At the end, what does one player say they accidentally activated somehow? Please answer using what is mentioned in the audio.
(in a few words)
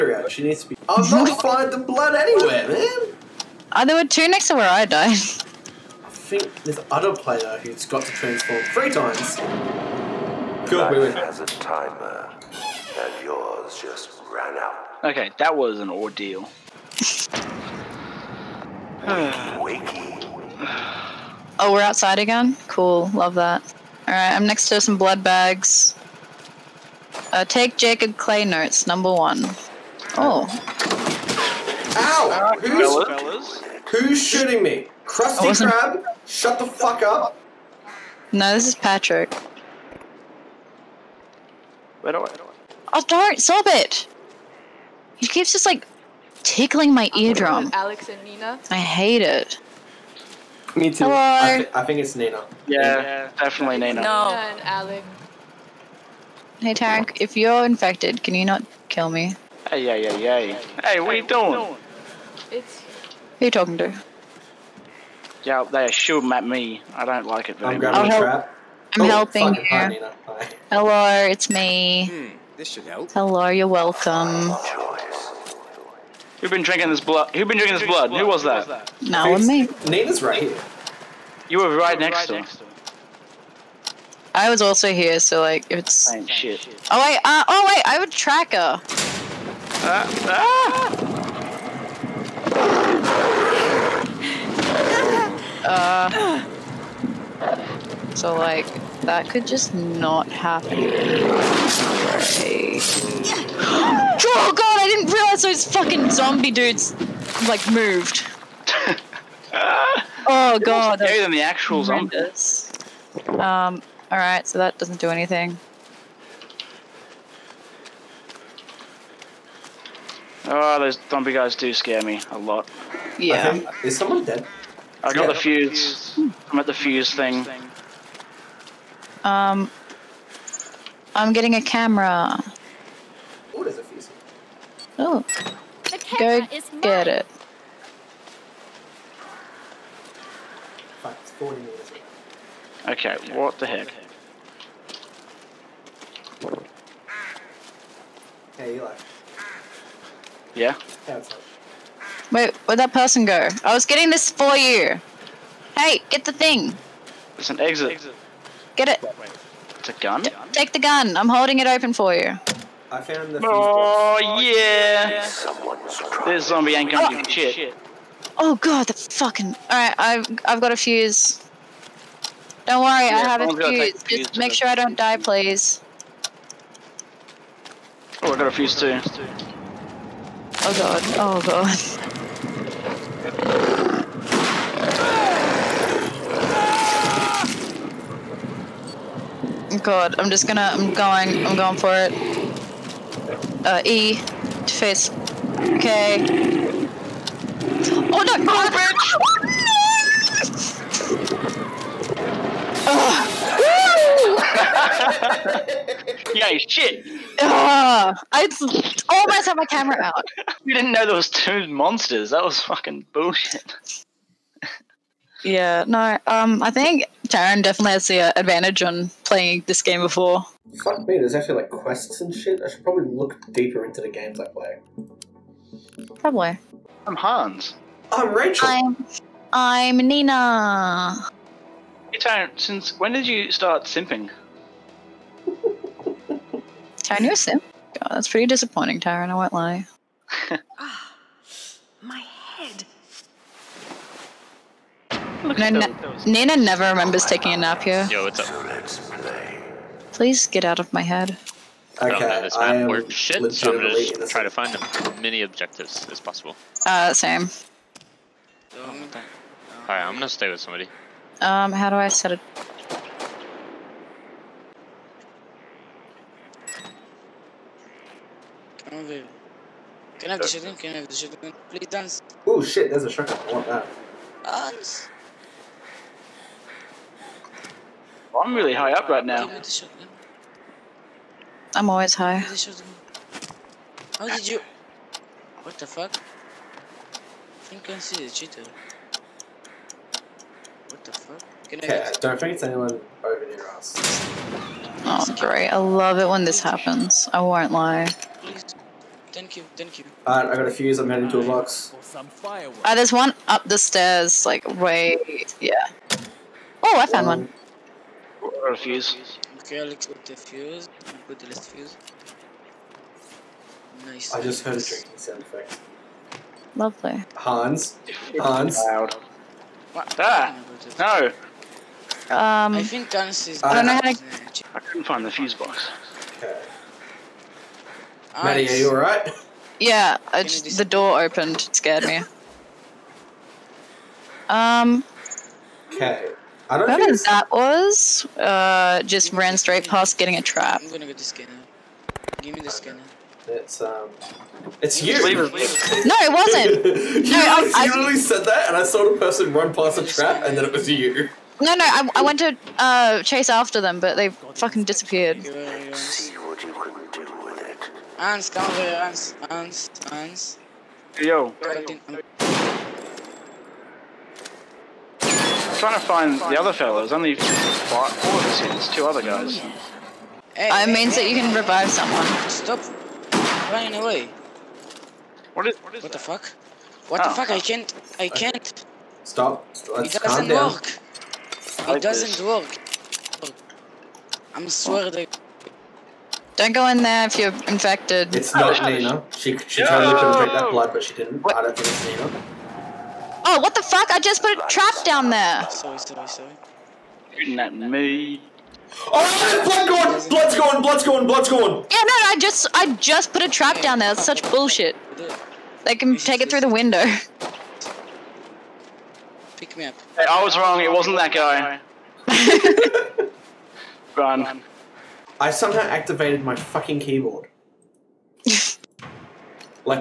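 keyboard.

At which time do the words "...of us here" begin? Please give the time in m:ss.
6:08.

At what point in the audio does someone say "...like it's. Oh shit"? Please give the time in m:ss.
1:25.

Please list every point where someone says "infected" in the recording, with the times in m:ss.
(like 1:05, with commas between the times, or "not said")
0:57, 6:27.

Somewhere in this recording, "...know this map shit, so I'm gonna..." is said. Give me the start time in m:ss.
4:12.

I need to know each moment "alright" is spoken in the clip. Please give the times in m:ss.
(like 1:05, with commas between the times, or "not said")
0:24, 4:18, 5:00, 5:28.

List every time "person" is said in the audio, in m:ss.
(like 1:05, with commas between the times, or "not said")
2:32, 5:49.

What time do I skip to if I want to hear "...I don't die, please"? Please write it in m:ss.
2:54.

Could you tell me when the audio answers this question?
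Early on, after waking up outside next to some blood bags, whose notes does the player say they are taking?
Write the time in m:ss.
0:27.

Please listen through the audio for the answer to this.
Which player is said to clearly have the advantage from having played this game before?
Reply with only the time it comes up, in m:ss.
3:37.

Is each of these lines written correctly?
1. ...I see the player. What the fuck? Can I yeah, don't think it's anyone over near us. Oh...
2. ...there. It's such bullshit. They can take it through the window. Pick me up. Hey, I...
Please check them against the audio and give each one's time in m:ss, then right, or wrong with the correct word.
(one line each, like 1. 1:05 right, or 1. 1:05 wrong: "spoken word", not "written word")
1. 4:47 wrong: "cheater", not "player"
2. 6:43 right.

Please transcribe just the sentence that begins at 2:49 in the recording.
All right, I've I've got a fuse.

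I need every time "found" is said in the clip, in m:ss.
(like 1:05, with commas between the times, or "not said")
2:43, 5:07.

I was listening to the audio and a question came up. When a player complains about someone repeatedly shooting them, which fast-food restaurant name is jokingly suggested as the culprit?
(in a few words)
Krusty Krab.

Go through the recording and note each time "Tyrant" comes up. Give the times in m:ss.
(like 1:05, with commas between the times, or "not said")
3:52, 3:58.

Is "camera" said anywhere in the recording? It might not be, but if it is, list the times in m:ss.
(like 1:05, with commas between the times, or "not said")
2:11, 3:29.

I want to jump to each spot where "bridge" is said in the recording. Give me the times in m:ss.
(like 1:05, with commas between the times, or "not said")
3:18.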